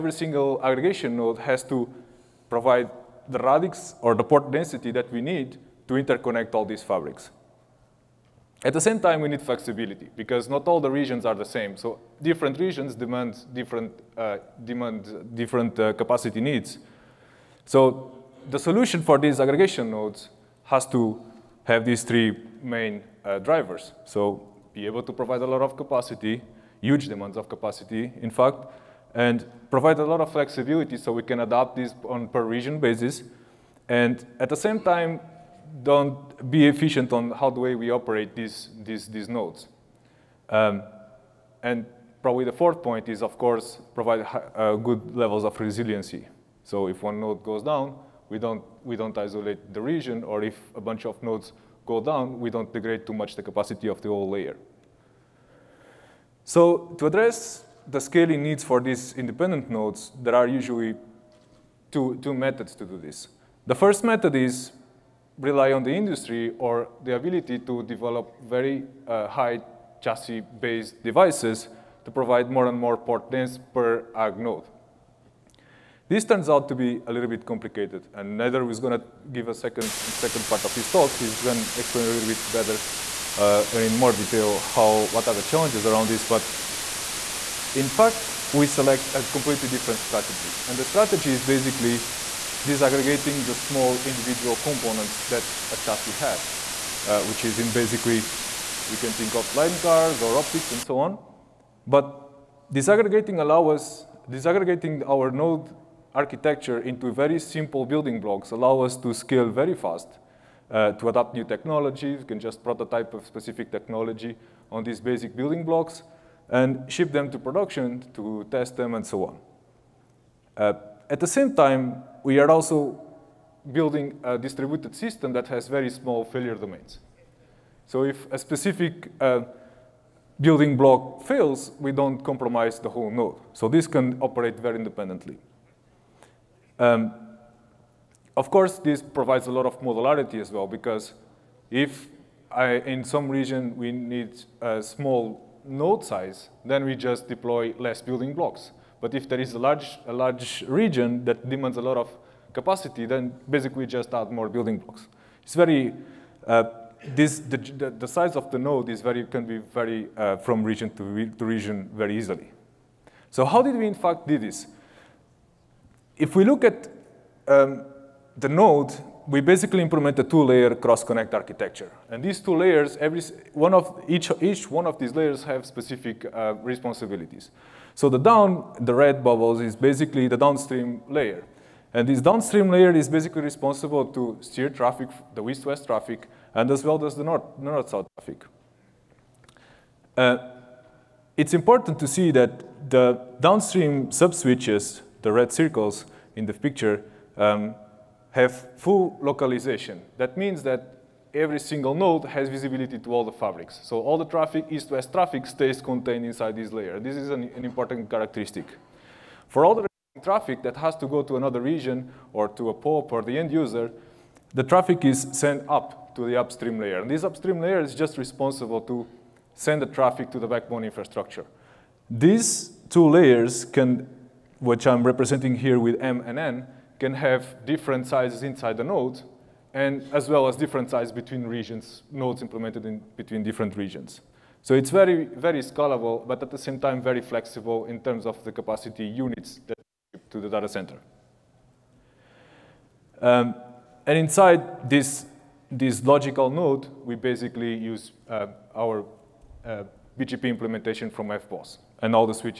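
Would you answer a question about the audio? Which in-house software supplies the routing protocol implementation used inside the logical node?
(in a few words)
FBOSS.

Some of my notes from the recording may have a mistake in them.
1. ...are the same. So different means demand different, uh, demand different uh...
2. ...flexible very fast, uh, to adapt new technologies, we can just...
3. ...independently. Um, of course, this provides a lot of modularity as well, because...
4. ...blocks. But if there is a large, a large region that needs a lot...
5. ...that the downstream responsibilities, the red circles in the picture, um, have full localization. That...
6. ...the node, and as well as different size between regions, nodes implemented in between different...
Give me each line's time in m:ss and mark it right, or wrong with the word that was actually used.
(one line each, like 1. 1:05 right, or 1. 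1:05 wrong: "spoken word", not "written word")
1. 0:11 wrong: "regions", not "means"
2. 1:49 wrong: "scale", not "flexible"
3. 2:14 right
4. 2:28 wrong: "demands", not "needs"
5. 3:12 wrong: "subswitches", not "responsibilities"
6. 3:48 right.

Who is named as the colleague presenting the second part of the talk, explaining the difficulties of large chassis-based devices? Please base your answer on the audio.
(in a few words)
Nader.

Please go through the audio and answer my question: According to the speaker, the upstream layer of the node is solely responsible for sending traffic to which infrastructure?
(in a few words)
Backbone infrastructure.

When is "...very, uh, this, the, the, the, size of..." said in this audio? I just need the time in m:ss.
2:35.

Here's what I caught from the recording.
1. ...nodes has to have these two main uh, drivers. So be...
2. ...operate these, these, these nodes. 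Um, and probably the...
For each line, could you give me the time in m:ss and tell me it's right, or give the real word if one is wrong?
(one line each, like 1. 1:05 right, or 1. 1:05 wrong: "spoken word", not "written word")
1. 0:19 wrong: "three", not "two"
2. 0:37 right.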